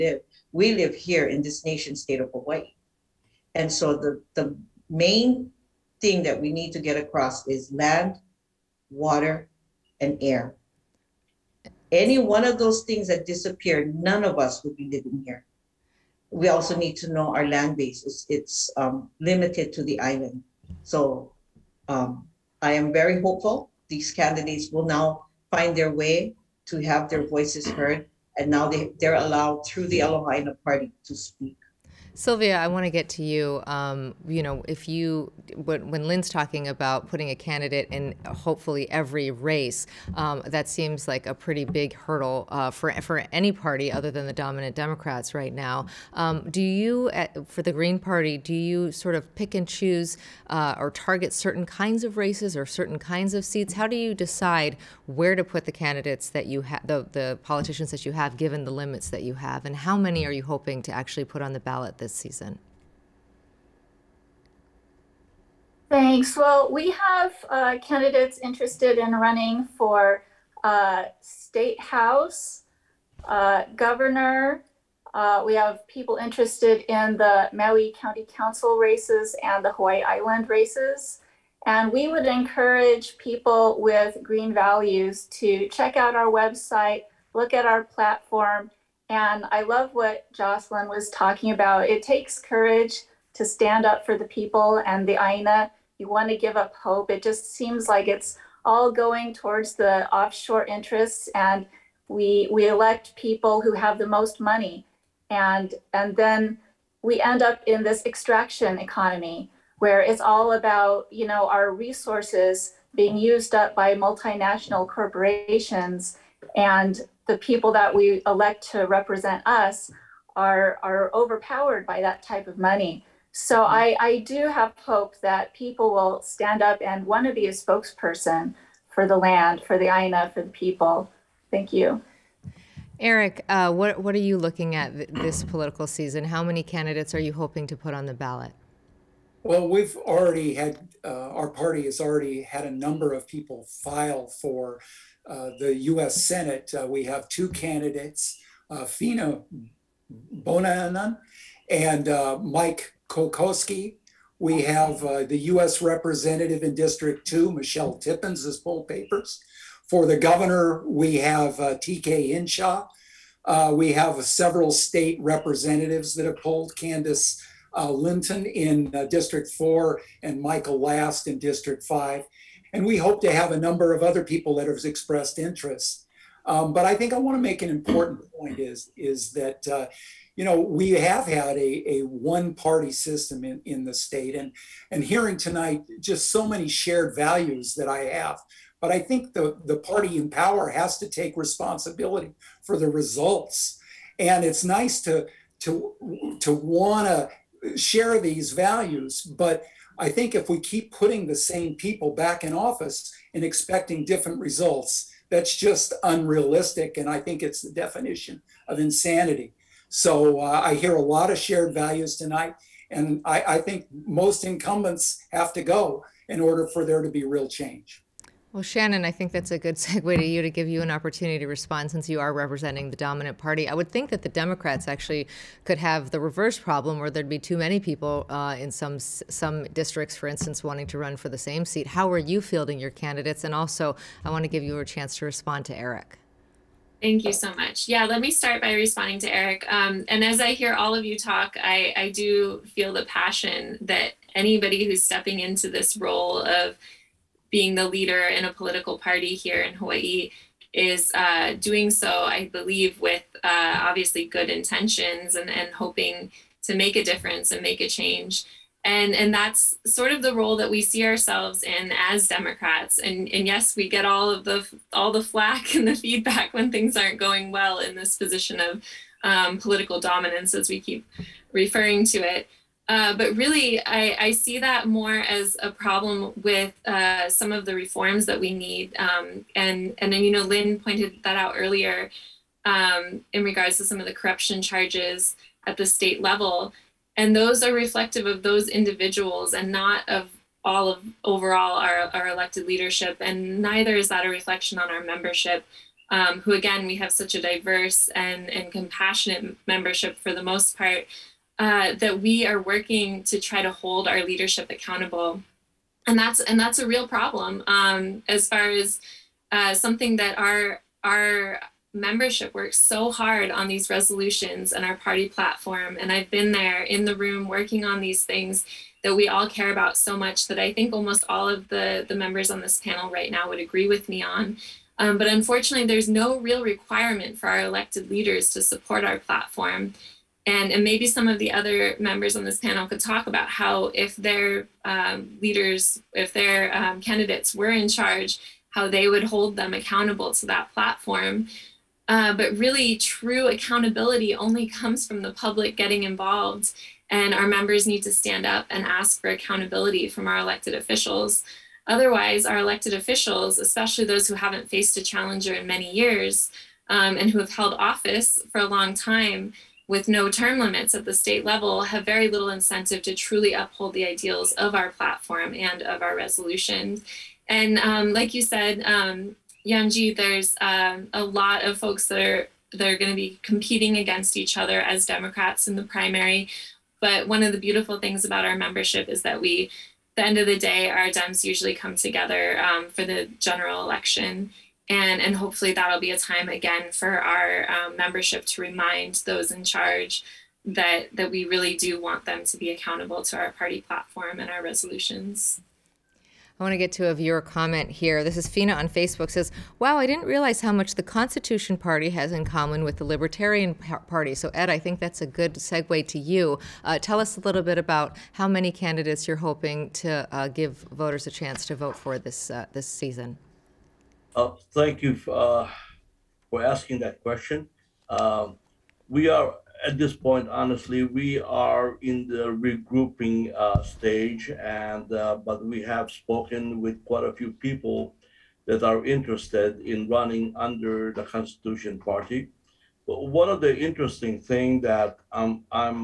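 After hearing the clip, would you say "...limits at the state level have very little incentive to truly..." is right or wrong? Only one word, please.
right.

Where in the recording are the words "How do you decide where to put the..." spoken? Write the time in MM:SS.
00:53.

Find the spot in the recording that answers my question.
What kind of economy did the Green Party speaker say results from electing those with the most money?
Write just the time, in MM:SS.
01:48.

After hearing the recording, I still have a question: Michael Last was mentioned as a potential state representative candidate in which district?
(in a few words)
District 5.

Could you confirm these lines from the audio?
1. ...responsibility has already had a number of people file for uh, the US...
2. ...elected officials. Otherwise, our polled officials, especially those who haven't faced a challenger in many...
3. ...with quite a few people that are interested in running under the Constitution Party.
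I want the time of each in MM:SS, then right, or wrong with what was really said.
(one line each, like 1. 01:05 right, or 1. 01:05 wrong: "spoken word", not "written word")
1. 02:21 wrong: "party", not "responsibility"
2. 05:50 wrong: "elected", not "polled"
3. 07:06 right.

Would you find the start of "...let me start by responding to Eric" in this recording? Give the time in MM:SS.
03:58.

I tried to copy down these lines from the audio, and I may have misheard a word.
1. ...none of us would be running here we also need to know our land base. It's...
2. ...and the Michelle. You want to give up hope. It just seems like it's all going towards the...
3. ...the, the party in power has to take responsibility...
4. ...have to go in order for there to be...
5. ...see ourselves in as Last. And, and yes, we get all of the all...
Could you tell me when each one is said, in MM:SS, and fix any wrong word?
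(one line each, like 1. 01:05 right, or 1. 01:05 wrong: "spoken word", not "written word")
1. 00:13 wrong: "living", not "running"
2. 01:34 wrong: "Aina", not "Michelle"
3. 03:09 right
4. 03:35 right
5. 04:20 wrong: "Democrats", not "Last".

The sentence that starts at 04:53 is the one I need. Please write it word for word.
And neither is that a reflection on our membership.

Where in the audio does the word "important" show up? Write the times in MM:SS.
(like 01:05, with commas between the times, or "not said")
02:57.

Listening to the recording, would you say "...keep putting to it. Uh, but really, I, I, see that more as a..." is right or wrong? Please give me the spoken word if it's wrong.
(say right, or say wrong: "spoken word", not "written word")
wrong: "referring", not "putting".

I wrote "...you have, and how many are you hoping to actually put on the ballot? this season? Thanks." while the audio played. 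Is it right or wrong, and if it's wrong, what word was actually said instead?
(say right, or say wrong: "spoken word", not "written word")
right.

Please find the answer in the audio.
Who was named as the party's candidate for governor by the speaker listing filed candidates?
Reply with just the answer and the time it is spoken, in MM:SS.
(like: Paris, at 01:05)
TK Inshaw, at 02:41.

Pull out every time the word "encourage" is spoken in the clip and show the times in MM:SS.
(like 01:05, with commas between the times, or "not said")
01:22.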